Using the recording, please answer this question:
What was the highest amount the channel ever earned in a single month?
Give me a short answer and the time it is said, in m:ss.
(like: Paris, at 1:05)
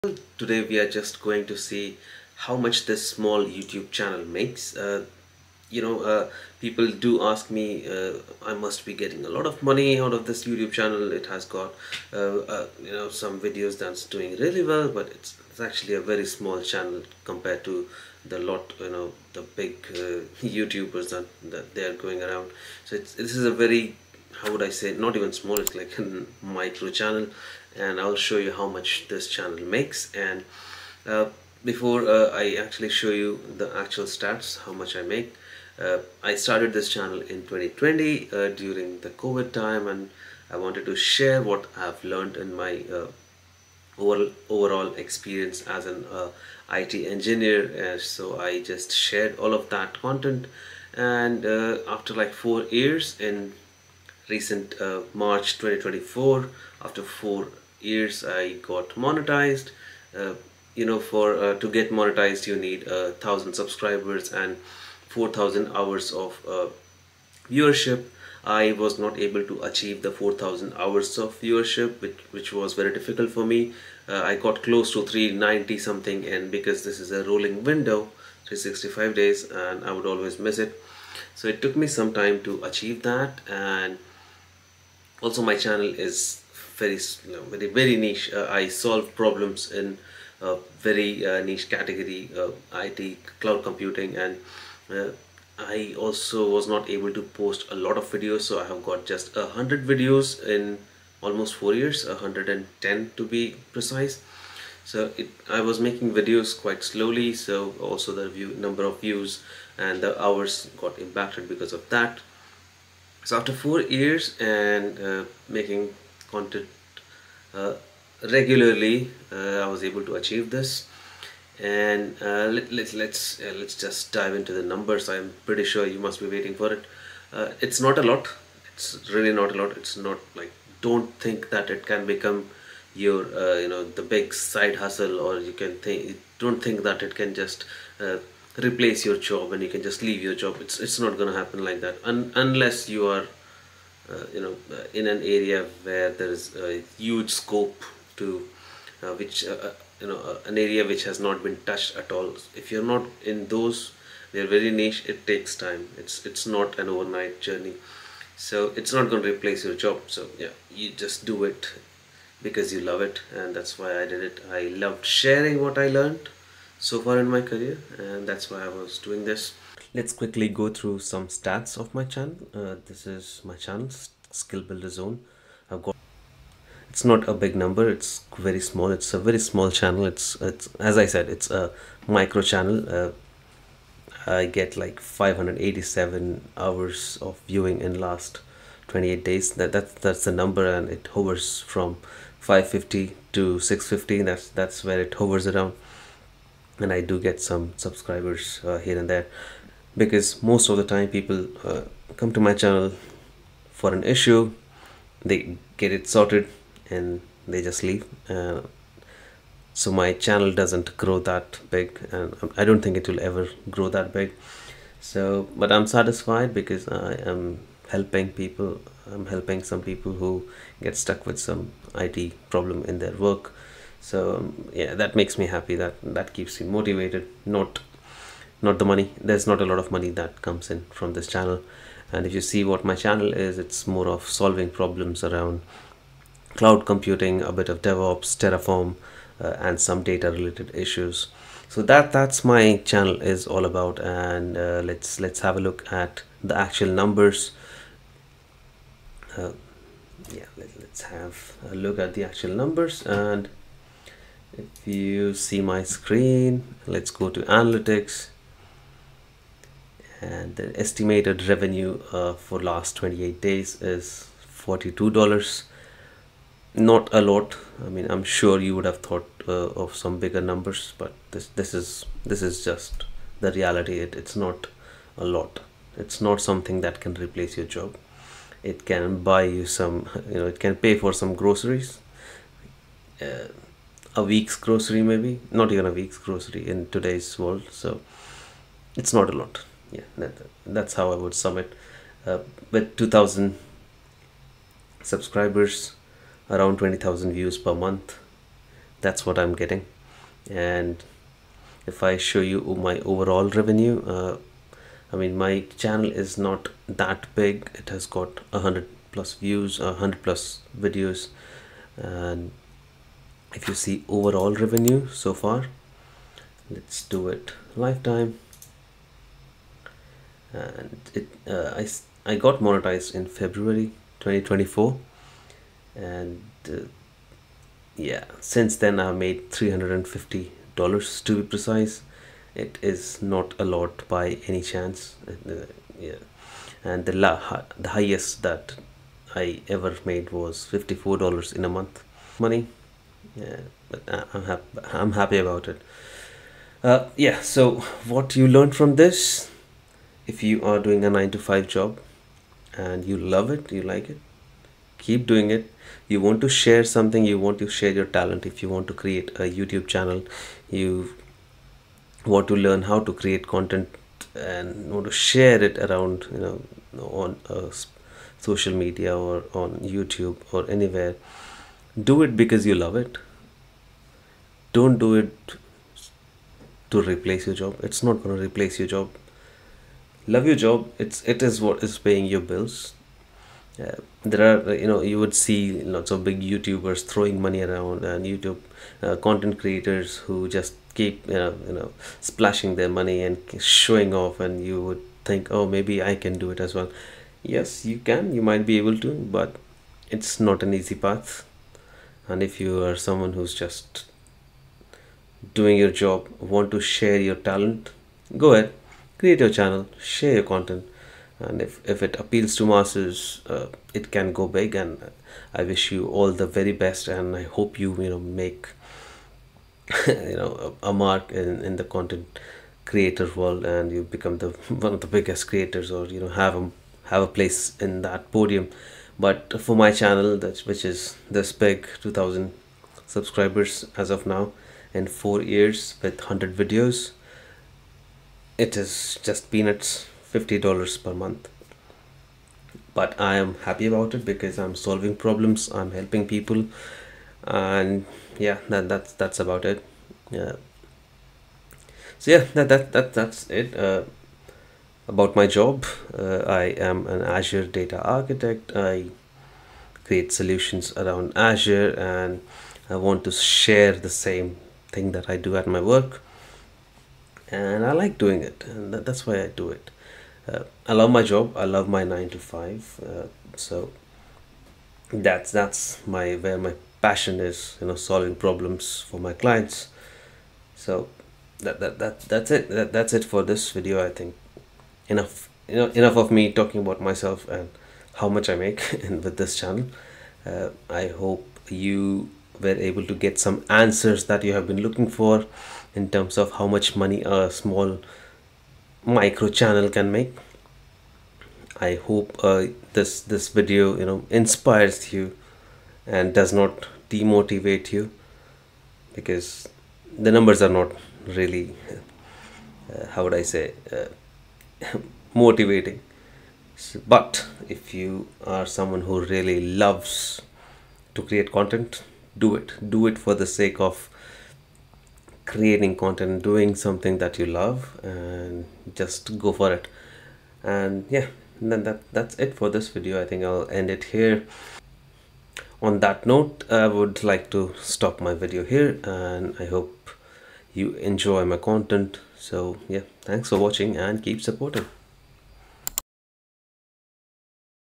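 $54, at 5:40.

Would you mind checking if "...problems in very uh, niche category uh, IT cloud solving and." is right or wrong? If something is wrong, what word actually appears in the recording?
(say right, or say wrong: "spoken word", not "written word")
wrong: "computing", not "solving".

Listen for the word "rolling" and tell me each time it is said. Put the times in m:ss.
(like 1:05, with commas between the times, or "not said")
1:17.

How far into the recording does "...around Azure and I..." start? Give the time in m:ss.
7:40.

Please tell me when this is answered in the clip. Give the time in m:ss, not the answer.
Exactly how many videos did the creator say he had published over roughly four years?
1:42.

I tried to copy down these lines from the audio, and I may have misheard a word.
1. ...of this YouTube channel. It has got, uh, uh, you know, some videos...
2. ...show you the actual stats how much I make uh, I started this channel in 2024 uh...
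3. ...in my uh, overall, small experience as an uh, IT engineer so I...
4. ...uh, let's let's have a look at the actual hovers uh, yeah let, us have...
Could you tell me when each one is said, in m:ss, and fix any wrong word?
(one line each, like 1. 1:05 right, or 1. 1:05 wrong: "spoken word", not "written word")
1. 0:10 right
2. 0:32 wrong: "2020", not "2024"
3. 0:42 wrong: "overall", not "small"
4. 4:04 wrong: "numbers", not "hovers".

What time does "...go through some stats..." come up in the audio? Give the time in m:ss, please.
2:50.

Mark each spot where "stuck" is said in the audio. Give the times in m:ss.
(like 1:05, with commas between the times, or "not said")
3:40.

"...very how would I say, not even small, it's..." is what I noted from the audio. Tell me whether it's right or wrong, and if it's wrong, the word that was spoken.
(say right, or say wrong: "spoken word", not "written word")
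right.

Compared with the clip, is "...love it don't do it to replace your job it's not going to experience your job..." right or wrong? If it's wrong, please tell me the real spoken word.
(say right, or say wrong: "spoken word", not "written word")
wrong: "replace", not "experience".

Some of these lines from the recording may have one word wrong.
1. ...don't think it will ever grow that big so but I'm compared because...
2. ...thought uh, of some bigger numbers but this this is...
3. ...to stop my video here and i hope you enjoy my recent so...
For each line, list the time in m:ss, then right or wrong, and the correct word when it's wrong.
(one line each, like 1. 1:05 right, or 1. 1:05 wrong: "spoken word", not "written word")
1. 3:32 wrong: "satisfied", not "compared"
2. 4:28 right
3. 8:57 wrong: "content", not "recent".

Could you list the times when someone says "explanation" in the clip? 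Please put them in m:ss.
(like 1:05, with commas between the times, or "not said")
not said.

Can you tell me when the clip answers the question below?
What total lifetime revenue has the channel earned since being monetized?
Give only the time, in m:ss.
5:29.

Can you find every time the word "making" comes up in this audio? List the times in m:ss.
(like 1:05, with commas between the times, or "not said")
1:45, 1:55.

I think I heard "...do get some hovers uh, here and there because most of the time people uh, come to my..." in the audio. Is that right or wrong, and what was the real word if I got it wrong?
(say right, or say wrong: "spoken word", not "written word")
wrong: "subscribers", not "hovers".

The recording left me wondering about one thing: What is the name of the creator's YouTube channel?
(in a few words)
Skill Builder Zone.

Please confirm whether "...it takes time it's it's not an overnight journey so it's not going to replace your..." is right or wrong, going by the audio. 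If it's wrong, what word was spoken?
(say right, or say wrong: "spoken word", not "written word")
right.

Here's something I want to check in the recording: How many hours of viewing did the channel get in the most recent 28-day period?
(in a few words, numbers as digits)
587.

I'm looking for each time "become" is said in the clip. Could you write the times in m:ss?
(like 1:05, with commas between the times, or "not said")
2:12, 7:04.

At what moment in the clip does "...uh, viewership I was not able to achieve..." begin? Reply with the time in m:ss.
1:06.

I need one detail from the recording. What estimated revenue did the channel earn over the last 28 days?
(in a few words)
$42.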